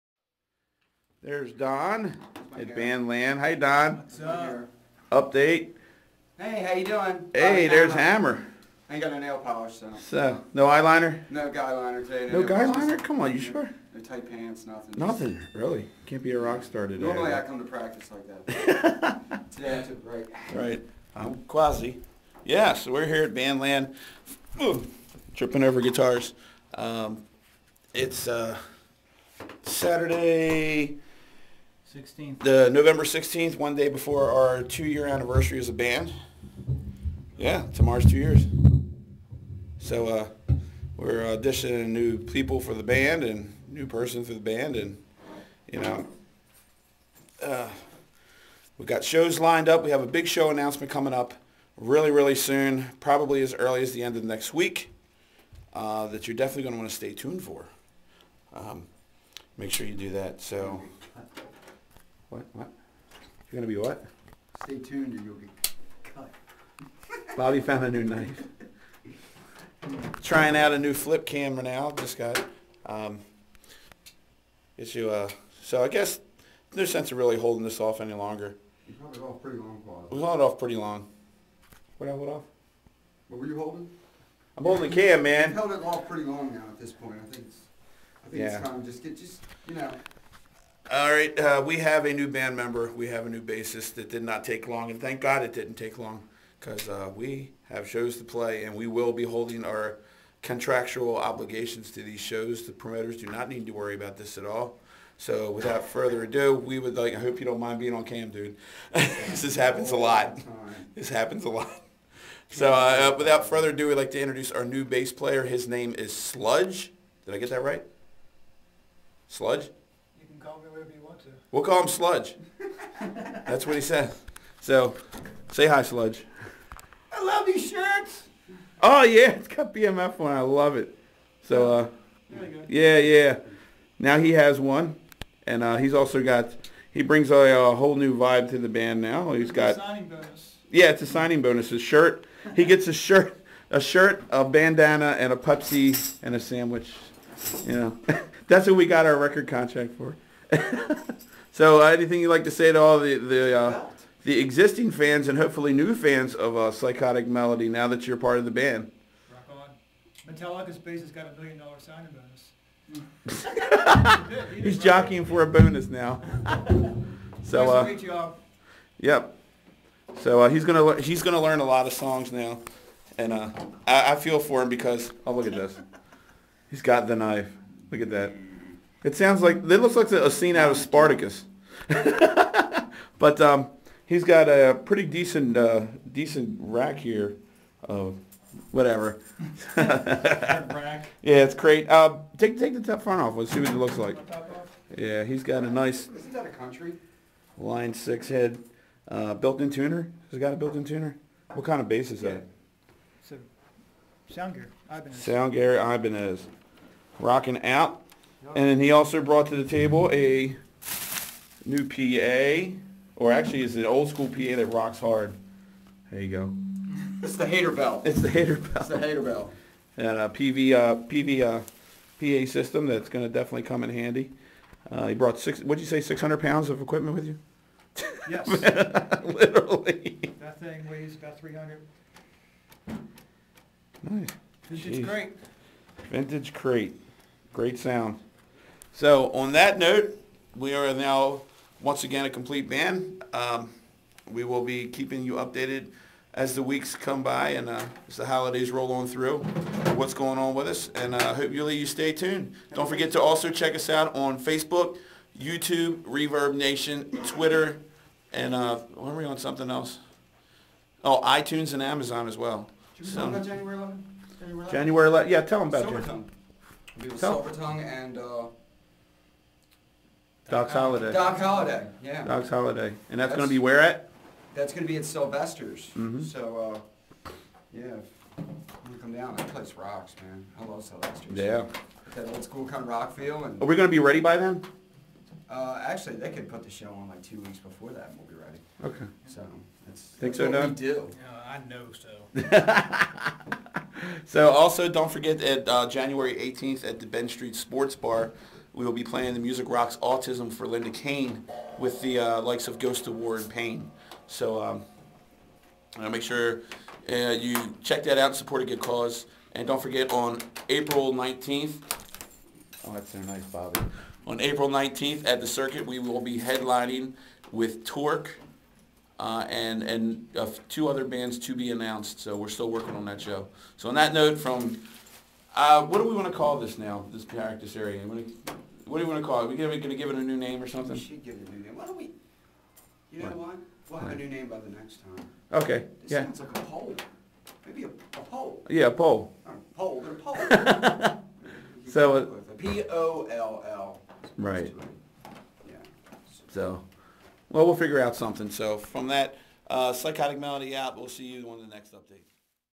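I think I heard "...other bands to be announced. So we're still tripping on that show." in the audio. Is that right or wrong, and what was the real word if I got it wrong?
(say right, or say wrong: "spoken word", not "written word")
wrong: "working", not "tripping".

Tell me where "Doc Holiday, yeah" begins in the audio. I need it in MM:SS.
04:31.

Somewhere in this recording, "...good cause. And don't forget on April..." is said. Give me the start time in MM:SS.
05:08.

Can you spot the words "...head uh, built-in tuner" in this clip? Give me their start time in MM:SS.
03:18.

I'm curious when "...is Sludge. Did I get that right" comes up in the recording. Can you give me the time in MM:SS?
01:55.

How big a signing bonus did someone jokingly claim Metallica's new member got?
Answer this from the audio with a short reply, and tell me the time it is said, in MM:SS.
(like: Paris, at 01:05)
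million dollar, at 02:41.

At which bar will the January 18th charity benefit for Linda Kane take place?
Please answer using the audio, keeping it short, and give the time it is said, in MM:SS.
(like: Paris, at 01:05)
Ben Street Sports Bar, at 04:57.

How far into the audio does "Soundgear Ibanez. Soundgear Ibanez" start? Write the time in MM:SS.
03:24.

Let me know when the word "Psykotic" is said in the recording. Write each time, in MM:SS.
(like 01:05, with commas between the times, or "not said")
02:36, 05:49.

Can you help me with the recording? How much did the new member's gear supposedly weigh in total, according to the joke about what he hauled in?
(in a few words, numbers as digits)
600 pounds.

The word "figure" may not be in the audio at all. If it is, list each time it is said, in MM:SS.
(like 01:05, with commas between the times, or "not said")
05:47.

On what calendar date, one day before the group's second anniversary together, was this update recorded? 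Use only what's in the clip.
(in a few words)
November 16th.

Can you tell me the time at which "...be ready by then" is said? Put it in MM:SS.
04:43.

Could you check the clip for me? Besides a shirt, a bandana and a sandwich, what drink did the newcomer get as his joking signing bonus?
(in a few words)
Pepsi.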